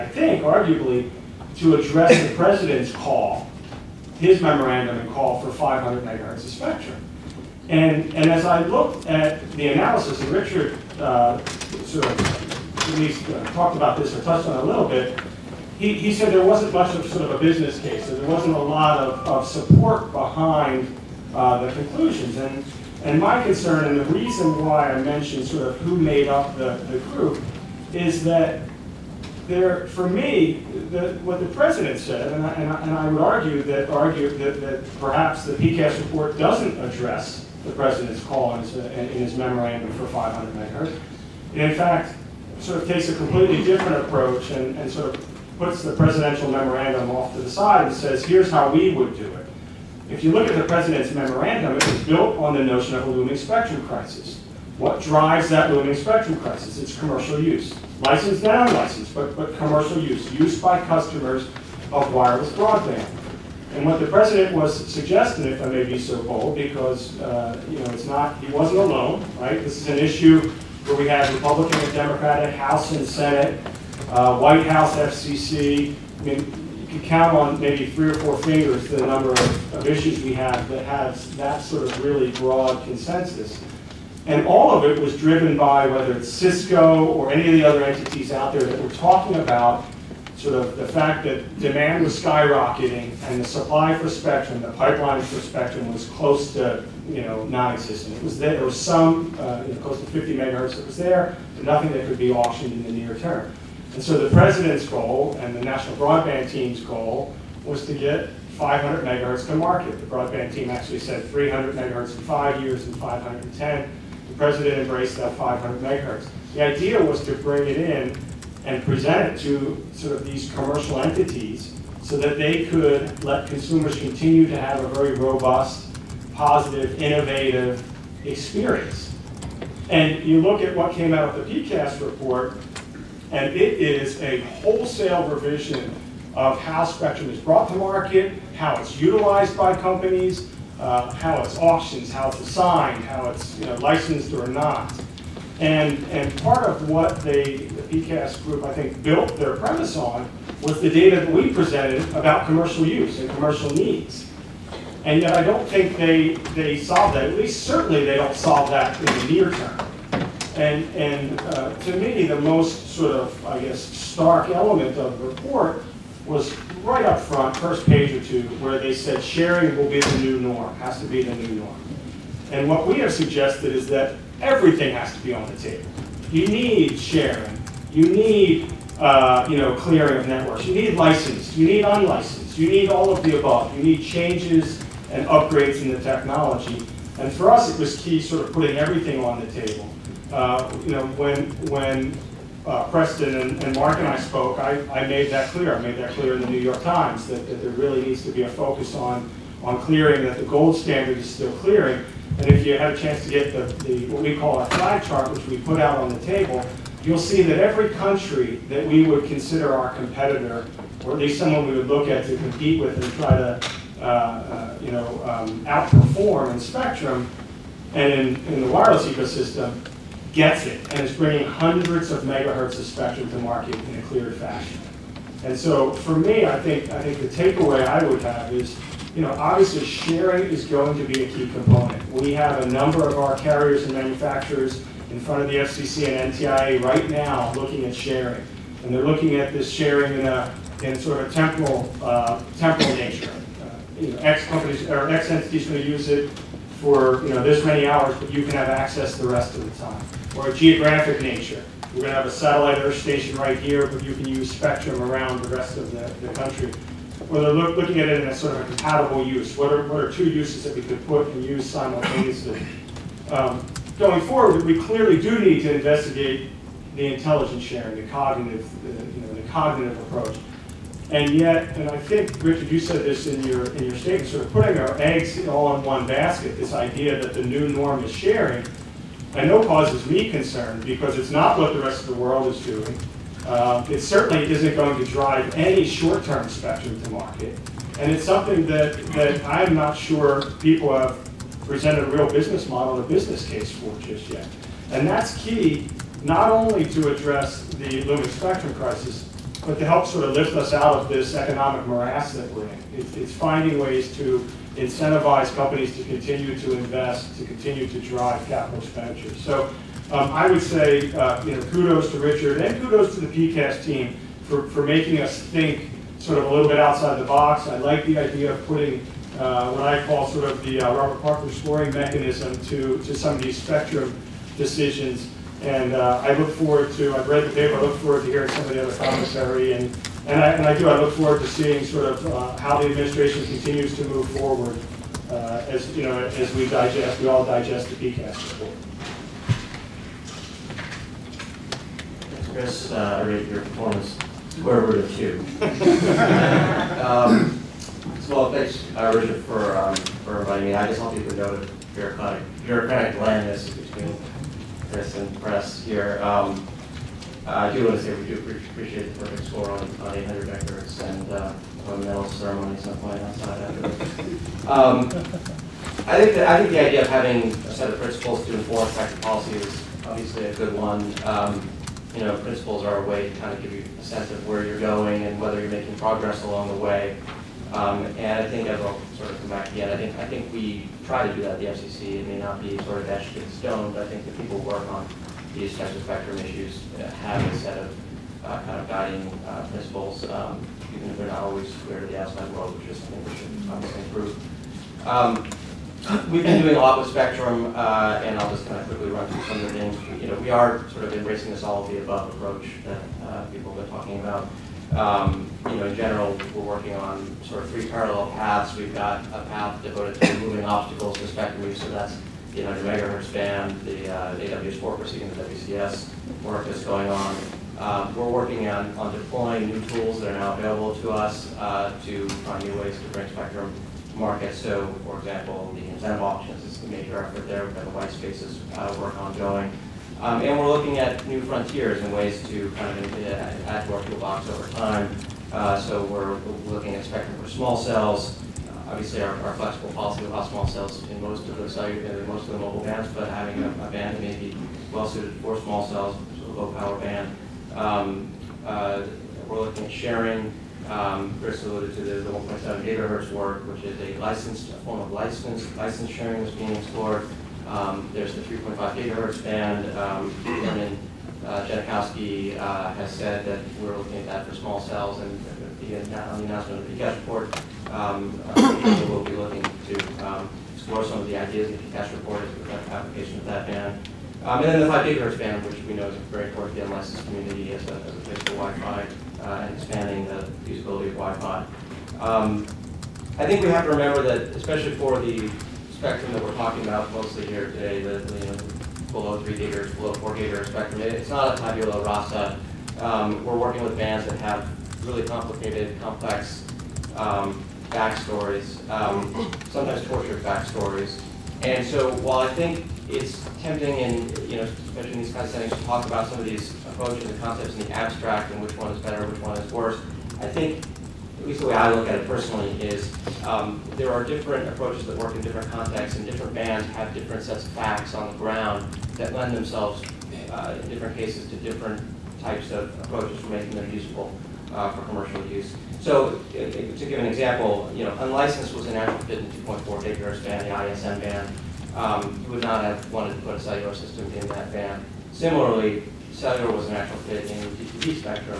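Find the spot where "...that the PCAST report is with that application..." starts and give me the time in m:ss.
7:51.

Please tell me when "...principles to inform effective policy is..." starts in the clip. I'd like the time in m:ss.
6:08.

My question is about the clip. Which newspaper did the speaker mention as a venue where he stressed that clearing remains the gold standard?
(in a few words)
New York Times.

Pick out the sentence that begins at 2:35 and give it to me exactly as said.
And yet I don't think they, they solved that.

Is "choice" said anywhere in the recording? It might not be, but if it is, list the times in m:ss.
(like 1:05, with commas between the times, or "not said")
not said.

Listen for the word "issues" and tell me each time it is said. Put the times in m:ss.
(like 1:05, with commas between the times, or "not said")
1:09, 1:19, 6:26.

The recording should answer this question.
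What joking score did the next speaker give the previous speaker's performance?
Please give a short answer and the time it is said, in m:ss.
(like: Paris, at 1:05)
square root of two, at 5:44.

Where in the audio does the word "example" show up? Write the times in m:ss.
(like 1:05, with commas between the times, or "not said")
7:05, 8:47.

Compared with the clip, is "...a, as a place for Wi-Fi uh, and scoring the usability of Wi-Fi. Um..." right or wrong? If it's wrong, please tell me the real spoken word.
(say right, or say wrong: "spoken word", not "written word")
wrong: "expanding", not "scoring".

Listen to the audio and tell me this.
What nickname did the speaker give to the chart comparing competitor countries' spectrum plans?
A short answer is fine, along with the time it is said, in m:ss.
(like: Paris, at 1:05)
flag chart, at 3:24.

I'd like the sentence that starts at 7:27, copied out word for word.
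Um, uh, we're looking at sharing.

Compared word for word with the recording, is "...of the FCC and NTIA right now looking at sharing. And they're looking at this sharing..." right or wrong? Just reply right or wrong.
right.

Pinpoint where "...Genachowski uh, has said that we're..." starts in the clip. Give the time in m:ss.
7:41.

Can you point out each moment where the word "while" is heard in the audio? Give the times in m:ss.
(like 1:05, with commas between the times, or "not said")
8:22.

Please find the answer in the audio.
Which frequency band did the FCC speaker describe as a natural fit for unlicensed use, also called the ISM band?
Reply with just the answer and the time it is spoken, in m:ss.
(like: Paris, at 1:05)
2.4 gigahertz, at 8:49.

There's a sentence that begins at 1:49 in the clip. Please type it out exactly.
The broadband team actually said 300 megahertz in five years and 510.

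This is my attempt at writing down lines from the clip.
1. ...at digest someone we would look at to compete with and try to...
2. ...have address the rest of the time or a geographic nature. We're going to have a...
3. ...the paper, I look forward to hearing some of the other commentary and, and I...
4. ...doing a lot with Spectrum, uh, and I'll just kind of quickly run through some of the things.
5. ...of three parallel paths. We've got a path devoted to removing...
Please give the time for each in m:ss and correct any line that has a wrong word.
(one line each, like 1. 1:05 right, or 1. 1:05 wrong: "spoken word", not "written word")
1. 3:31 wrong: "least", not "digest"
2. 4:08 wrong: "access", not "address"
3. 5:27 right
4. 6:36 right
5. 6:47 right.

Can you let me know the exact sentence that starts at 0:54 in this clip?
What drives that looming spectrum crisis?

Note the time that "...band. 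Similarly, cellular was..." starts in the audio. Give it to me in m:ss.
8:54.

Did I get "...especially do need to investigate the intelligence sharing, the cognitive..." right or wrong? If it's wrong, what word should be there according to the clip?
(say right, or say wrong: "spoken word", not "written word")
wrong: "clearly", not "especially".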